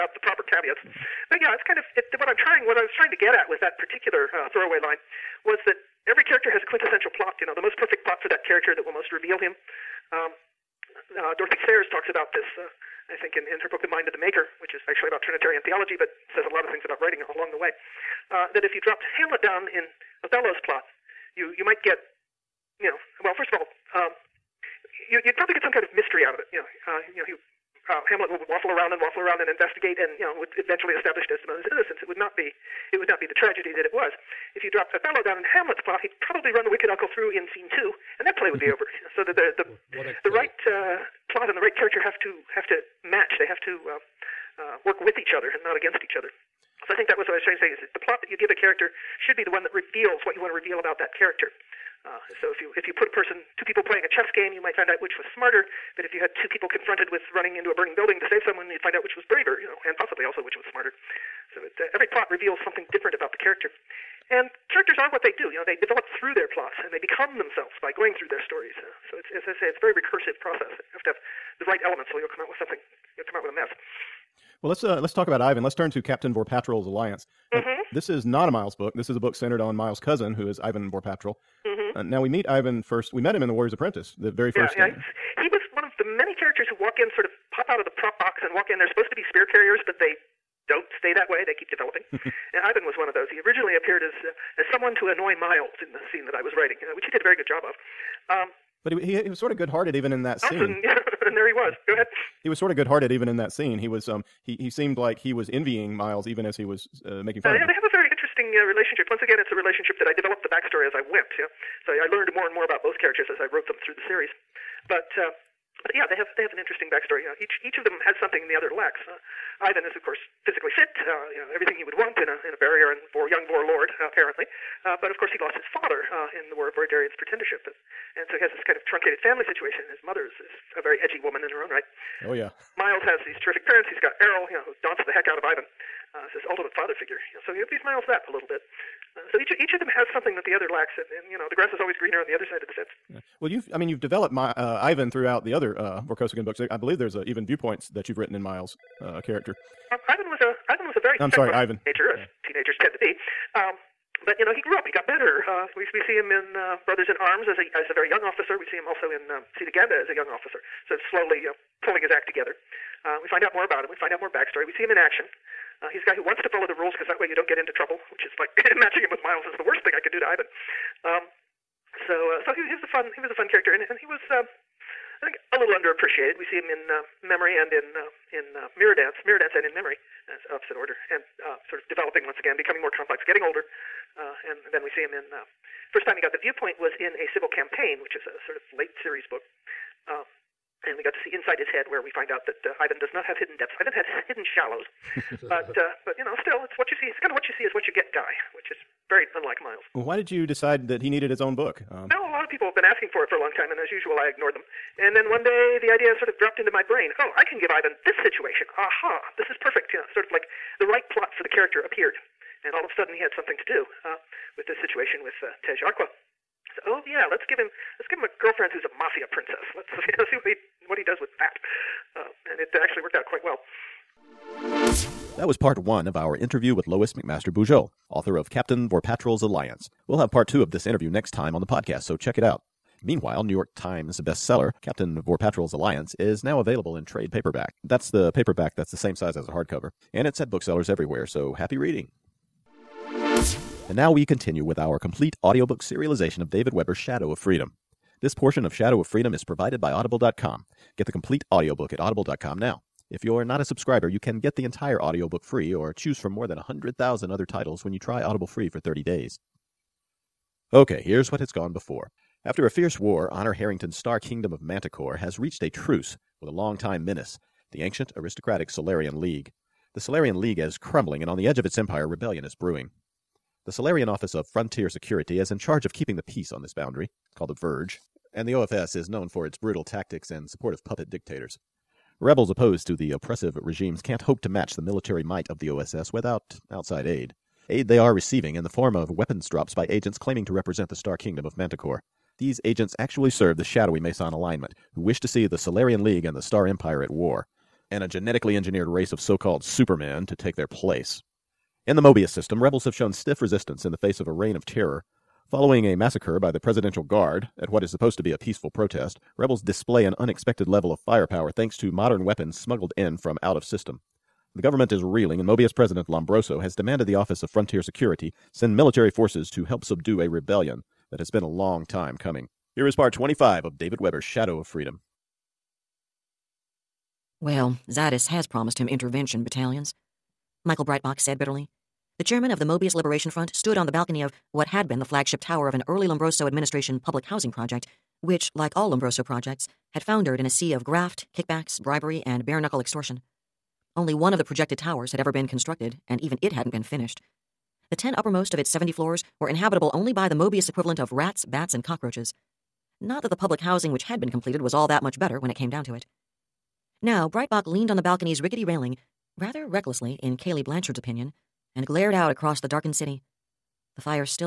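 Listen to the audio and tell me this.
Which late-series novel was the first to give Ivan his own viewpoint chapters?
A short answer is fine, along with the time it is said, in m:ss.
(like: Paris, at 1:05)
A Civil Campaign, at 3:07.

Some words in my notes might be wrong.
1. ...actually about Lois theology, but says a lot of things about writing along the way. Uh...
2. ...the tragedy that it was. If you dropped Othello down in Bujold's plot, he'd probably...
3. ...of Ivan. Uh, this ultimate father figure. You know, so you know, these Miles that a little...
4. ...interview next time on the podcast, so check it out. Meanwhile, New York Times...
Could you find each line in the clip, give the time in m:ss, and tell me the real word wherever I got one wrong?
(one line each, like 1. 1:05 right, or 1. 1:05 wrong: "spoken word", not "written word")
1. 0:14 wrong: "Trinitarian", not "Lois"
2. 0:33 wrong: "Hamlet", not "Bujold"
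3. 2:15 right
4. 3:50 right.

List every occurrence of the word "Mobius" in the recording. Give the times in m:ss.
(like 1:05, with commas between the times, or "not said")
5:01, 5:15, 5:32, 5:50.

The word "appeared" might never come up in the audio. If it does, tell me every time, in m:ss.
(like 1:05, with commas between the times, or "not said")
1:33, 3:31.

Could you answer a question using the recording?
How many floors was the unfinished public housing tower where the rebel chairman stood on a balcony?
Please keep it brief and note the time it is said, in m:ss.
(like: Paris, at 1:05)
70, at 5:48.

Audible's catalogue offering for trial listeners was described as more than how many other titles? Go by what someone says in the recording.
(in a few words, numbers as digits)
100,000.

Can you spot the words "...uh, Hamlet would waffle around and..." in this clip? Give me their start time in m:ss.
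0:27.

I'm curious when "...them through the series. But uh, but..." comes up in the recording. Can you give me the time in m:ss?
1:53.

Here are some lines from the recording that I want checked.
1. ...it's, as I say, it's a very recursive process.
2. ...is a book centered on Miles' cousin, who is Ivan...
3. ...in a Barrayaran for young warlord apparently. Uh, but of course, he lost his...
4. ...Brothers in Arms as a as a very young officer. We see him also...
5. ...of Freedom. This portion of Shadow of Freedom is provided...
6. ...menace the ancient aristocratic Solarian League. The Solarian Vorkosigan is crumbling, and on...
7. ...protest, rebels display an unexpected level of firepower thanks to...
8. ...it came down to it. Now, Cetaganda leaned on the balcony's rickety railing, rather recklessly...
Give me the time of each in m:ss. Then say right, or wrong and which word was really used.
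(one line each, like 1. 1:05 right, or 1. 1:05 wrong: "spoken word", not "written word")
1. 1:09 right
2. 1:19 right
3. 2:02 right
4. 2:36 right
5. 4:07 right
6. 4:27 wrong: "League", not "Vorkosigan"
7. 5:08 right
8. 5:55 wrong: "Breitbach", not "Cetaganda".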